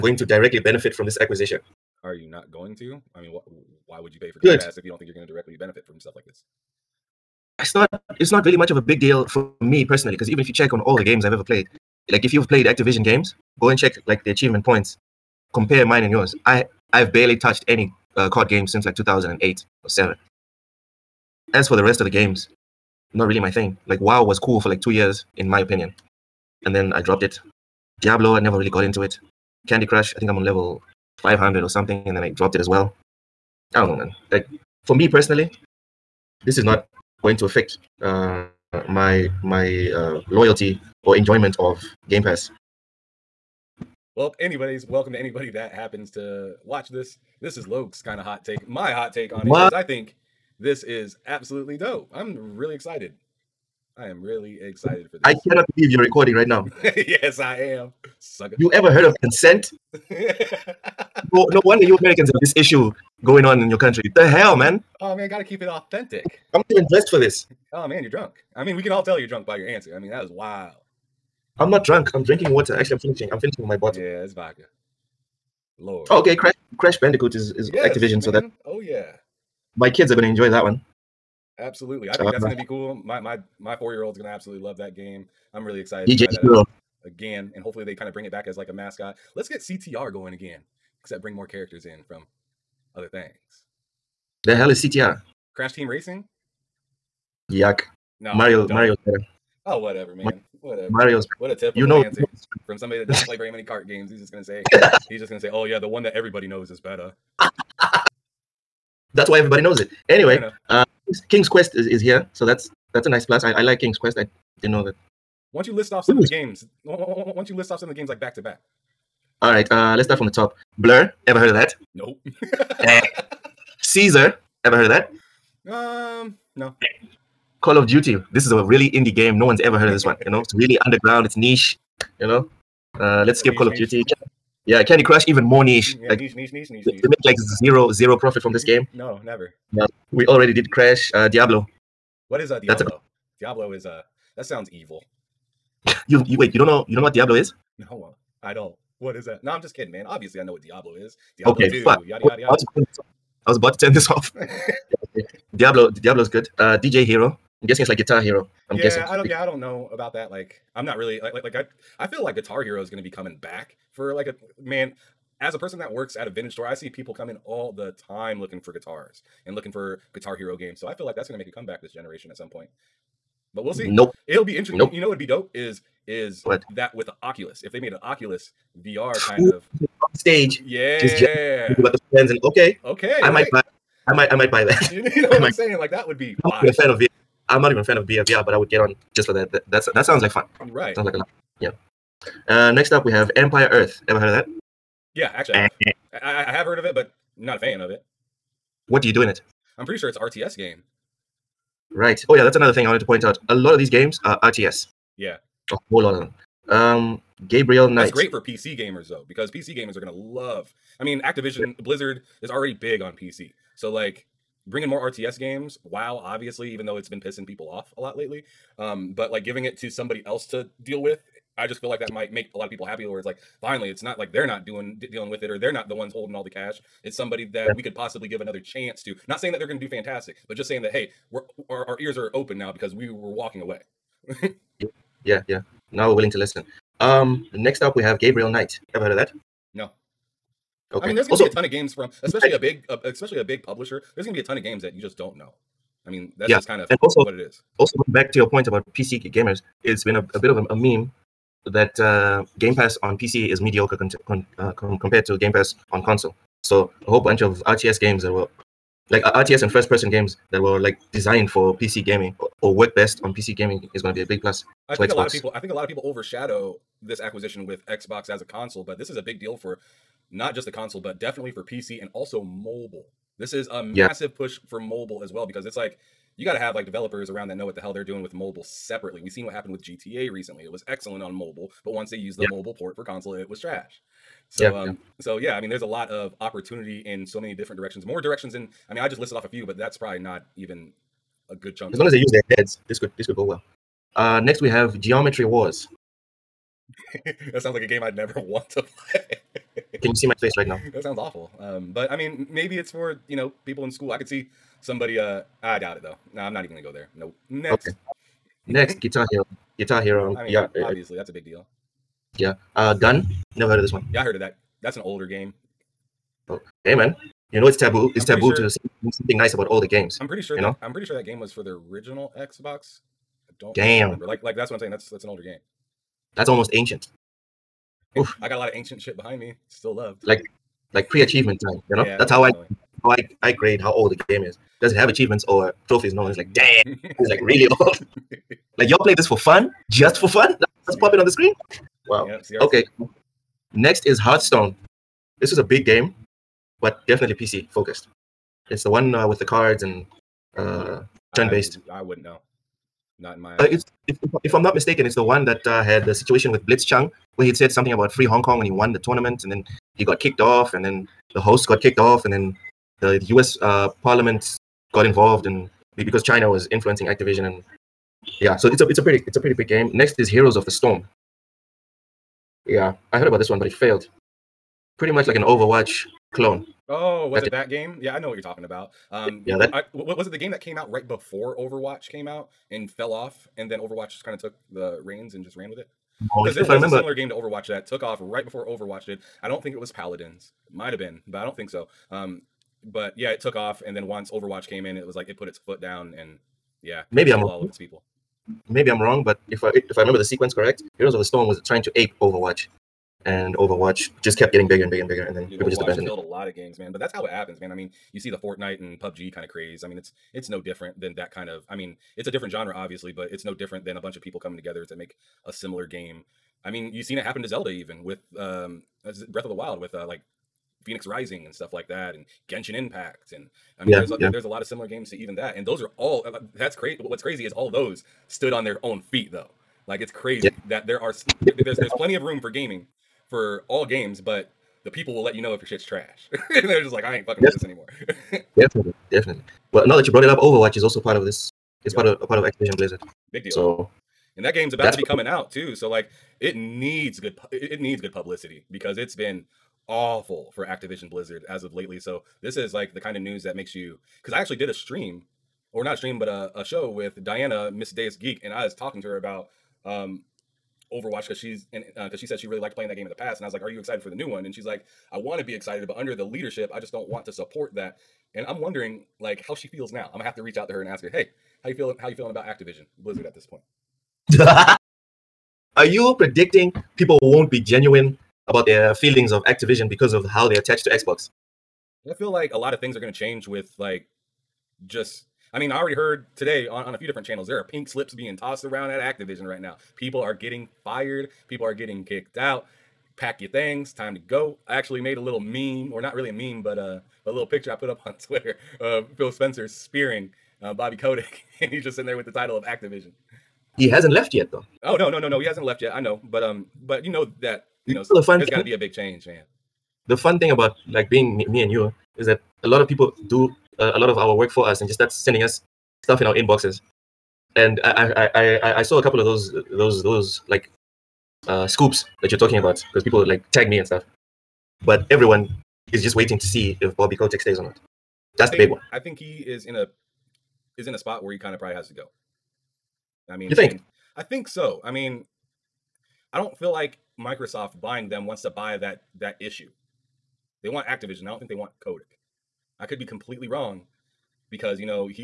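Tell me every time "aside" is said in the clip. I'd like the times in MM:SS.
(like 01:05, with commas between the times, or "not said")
not said.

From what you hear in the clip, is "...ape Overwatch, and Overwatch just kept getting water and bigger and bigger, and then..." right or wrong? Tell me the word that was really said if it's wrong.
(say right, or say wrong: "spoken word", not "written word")
wrong: "bigger", not "water".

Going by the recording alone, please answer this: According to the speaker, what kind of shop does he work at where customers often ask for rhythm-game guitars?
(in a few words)
vintage store.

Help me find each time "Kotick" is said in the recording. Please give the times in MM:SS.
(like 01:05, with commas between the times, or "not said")
08:20, 08:47.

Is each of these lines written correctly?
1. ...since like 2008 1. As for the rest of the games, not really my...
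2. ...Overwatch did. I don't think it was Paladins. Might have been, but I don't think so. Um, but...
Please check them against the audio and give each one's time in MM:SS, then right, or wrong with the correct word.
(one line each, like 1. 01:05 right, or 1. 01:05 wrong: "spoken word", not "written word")
1. 00:18 wrong: "7", not "1"
2. 06:28 right.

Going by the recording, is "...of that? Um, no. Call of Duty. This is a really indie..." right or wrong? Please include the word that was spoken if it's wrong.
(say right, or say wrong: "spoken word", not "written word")
right.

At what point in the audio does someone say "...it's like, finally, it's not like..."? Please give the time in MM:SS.
03:43.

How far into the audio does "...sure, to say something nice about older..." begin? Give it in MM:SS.
05:18.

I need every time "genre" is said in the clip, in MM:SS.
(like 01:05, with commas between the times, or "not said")
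06:52.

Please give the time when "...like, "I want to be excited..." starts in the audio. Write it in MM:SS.
07:44.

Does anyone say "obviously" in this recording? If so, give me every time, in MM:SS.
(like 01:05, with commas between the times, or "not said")
02:30, 03:36, 05:10, 06:52.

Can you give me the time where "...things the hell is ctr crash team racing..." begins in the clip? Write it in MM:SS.
01:33.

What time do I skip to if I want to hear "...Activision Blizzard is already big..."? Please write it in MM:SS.
03:31.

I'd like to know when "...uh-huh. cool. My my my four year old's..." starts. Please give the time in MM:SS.
01:22.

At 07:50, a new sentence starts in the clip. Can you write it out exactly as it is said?
I'm gonna have to reach out to her and ask her, "Hey, how you feeling?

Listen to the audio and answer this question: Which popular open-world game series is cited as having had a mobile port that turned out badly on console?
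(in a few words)
GTA.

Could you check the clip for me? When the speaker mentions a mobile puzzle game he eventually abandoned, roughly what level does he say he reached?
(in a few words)
500.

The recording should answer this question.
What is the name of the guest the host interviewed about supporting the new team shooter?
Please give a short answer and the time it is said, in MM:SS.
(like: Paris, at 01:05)
Miss Deus Geek, at 07:37.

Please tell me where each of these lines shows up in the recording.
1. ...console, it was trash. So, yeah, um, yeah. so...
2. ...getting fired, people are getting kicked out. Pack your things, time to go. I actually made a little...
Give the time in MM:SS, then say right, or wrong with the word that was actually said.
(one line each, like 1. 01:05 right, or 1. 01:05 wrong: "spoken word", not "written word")
1. 04:43 right
2. 08:10 right.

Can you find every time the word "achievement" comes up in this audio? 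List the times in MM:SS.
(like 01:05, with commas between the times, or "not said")
00:14, 05:31, 05:35.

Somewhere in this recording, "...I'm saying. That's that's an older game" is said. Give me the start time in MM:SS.
05:24.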